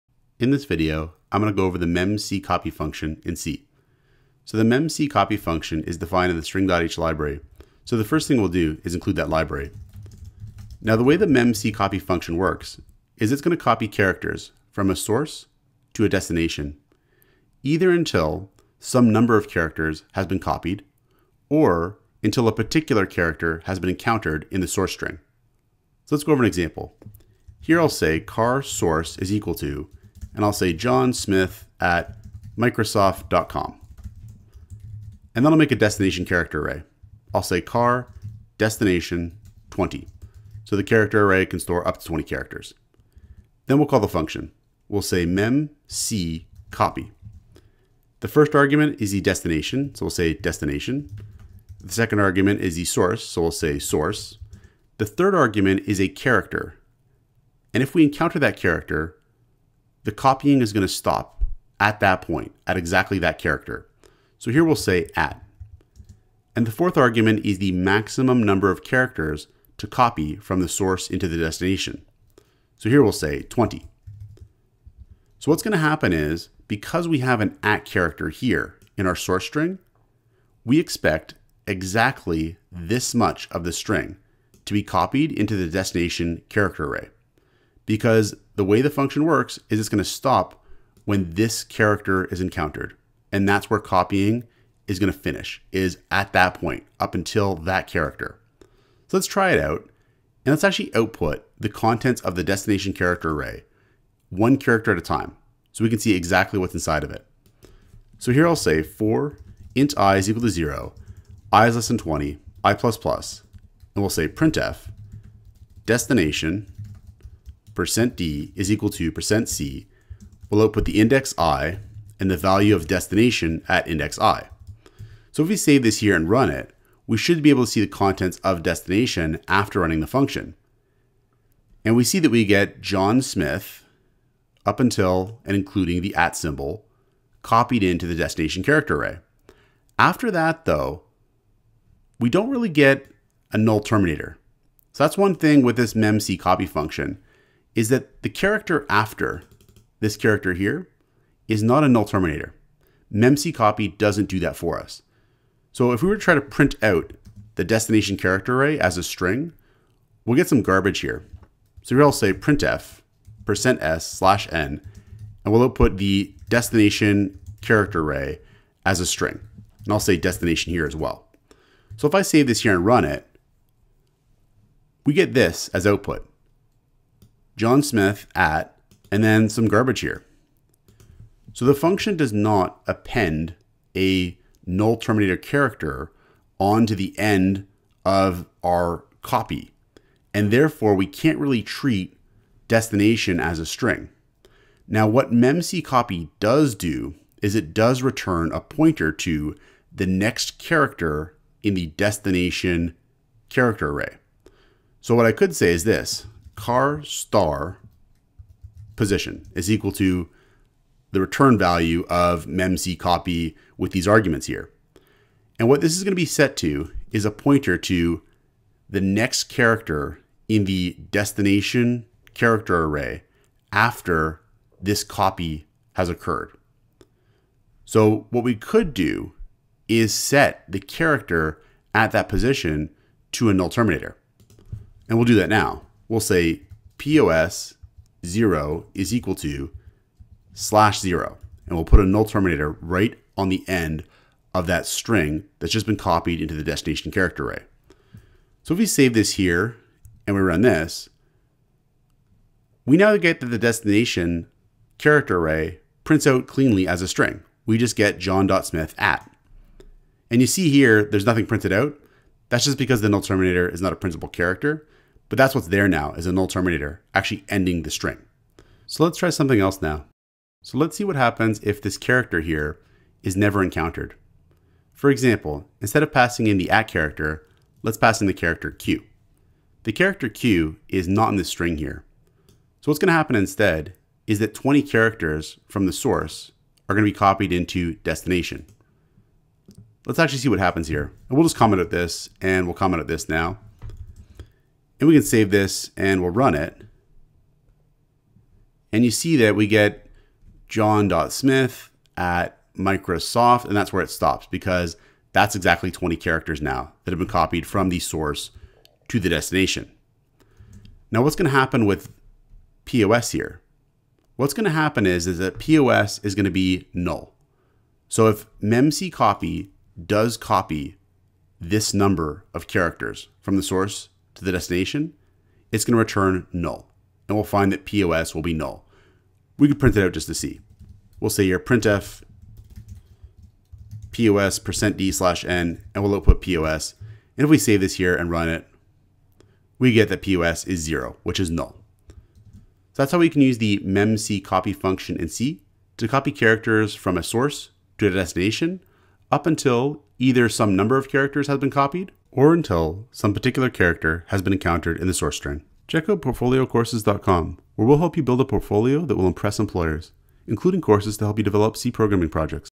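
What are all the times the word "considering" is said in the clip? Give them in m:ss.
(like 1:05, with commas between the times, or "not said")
not said.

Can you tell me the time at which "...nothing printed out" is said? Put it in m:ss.
4:21.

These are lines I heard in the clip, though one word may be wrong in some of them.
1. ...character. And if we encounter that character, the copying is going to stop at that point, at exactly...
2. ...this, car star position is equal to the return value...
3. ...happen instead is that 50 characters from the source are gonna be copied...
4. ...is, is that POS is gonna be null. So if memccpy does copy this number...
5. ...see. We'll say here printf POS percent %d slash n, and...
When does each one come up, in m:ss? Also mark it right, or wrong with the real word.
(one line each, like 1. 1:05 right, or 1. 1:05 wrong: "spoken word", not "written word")
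1. 0:56 right
2. 3:25 right
3. 4:43 wrong: "20", not "50"
4. 5:15 right
5. 5:30 right.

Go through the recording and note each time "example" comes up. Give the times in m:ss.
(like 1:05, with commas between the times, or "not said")
0:26, 4:35.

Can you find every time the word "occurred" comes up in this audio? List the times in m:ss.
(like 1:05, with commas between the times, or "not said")
3:46.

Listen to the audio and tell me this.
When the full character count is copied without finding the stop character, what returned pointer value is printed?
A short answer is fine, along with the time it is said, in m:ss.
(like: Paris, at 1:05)
0, at 5:40.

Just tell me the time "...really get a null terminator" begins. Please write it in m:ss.
2:22.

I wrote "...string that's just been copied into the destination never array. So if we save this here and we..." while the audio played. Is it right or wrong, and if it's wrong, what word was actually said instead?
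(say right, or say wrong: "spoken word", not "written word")
wrong: "character", not "never".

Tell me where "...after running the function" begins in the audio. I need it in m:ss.
2:09.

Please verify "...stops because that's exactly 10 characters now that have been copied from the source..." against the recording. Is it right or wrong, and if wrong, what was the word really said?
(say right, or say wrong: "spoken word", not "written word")
wrong: "20", not "10".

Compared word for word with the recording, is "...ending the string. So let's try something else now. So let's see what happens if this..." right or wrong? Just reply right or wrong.
right.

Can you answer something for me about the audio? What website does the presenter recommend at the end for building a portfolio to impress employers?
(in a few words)
PortfolioCourses.com.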